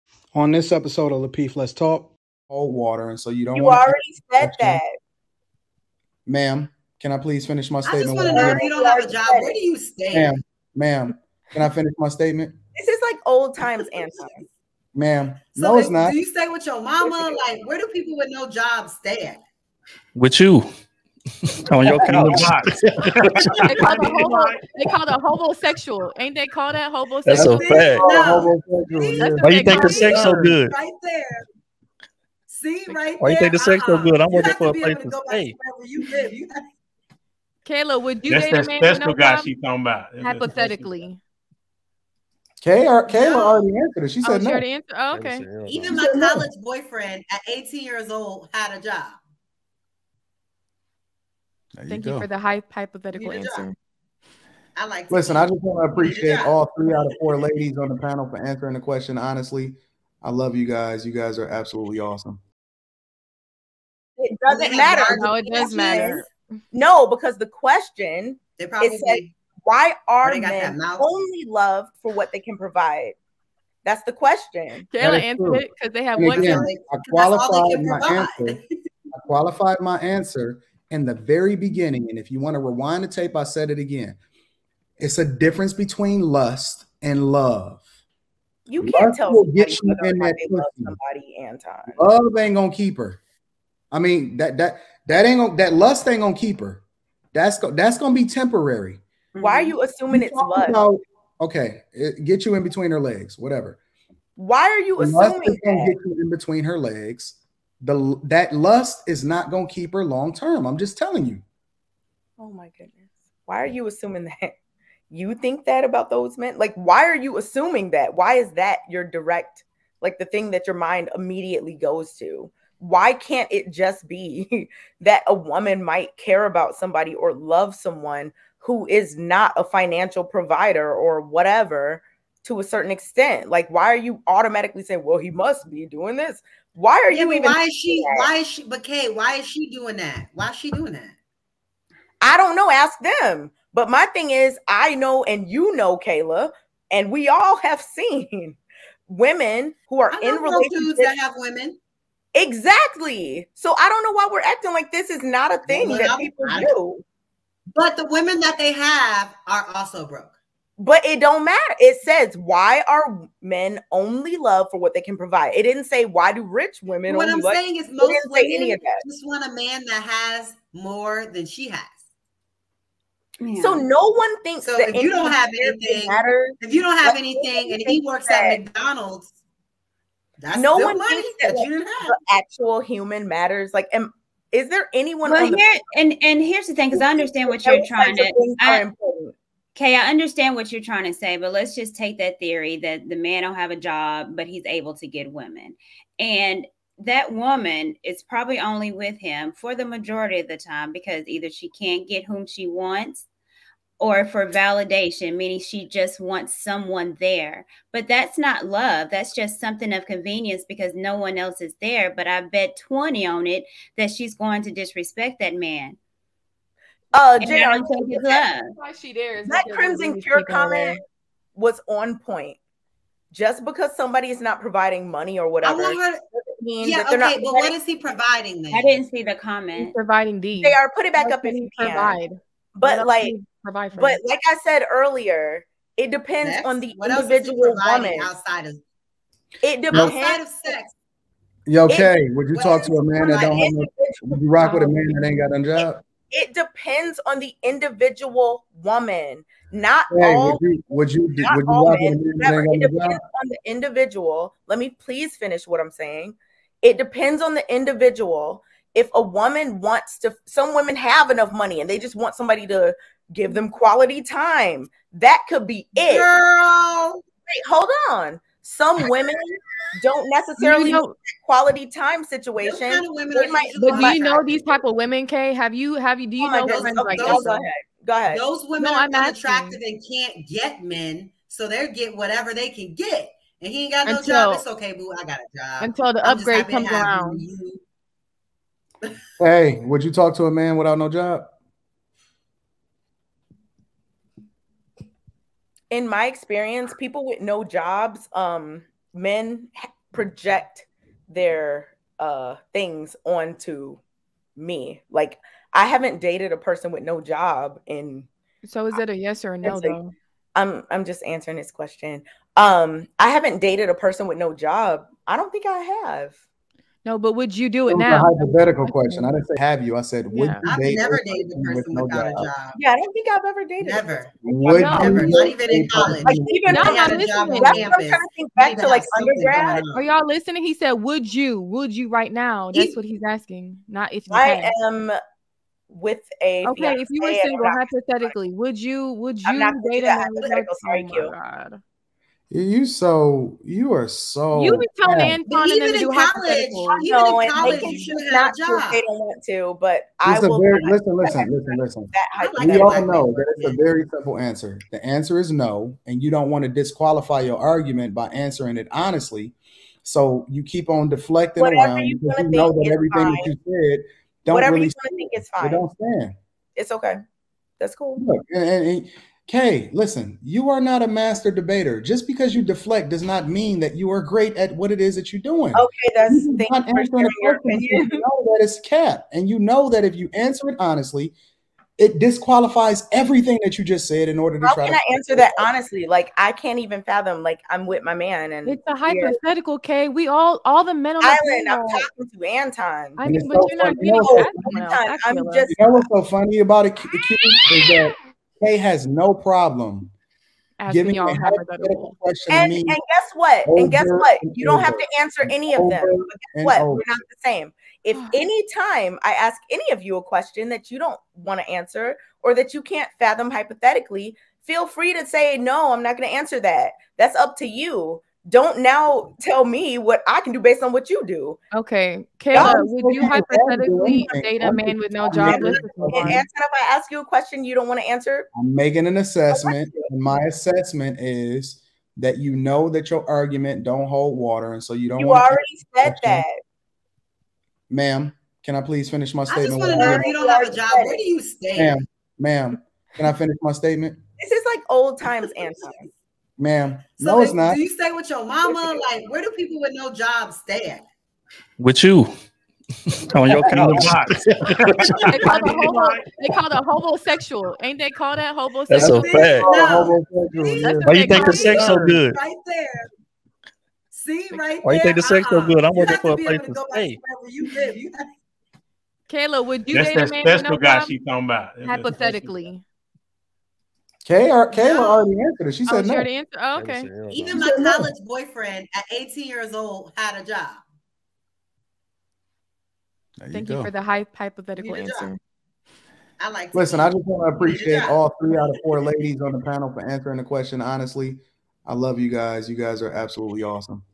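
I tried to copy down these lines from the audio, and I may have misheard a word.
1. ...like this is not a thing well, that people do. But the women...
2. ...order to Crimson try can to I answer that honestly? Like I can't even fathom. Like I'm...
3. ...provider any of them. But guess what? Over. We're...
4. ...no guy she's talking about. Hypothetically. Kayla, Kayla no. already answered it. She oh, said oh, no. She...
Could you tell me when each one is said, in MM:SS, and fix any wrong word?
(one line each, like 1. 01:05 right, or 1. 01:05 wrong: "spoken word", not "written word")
1. 02:34 right
2. 06:24 wrong: "How", not "Crimson"
3. 06:45 wrong: "answer", not "provider"
4. 07:50 right.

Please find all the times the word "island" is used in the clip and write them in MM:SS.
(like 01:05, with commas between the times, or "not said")
06:31.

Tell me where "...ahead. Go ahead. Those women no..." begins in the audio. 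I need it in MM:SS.
04:37.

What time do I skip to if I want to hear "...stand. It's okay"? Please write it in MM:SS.
06:05.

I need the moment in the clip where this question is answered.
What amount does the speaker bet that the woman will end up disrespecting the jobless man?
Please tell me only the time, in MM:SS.
03:32.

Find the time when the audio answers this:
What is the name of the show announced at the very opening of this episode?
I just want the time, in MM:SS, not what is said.
00:01.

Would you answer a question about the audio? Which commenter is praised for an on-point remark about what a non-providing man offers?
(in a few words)
Crimson Cure.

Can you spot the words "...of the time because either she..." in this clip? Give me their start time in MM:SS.
03:20.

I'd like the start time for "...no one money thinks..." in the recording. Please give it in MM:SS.
03:00.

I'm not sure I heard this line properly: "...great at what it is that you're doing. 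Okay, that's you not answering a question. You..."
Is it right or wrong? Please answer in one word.
right.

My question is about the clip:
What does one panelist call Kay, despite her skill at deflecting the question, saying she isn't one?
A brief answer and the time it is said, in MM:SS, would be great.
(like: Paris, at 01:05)
A master debater, at 06:11.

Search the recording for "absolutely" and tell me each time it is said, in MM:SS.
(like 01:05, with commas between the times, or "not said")
01:01, 08:13.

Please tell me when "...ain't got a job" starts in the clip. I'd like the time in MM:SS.
04:05.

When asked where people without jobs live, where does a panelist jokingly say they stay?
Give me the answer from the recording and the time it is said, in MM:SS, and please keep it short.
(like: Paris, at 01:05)
On your couch, at 07:33.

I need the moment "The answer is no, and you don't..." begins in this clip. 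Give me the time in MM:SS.
05:54.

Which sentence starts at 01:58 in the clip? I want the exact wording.
Why is that your direct like the thing that your mind immediately goes to?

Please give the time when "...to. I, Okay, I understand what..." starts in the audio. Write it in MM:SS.
03:08.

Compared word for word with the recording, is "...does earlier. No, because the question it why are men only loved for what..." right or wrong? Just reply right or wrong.
wrong.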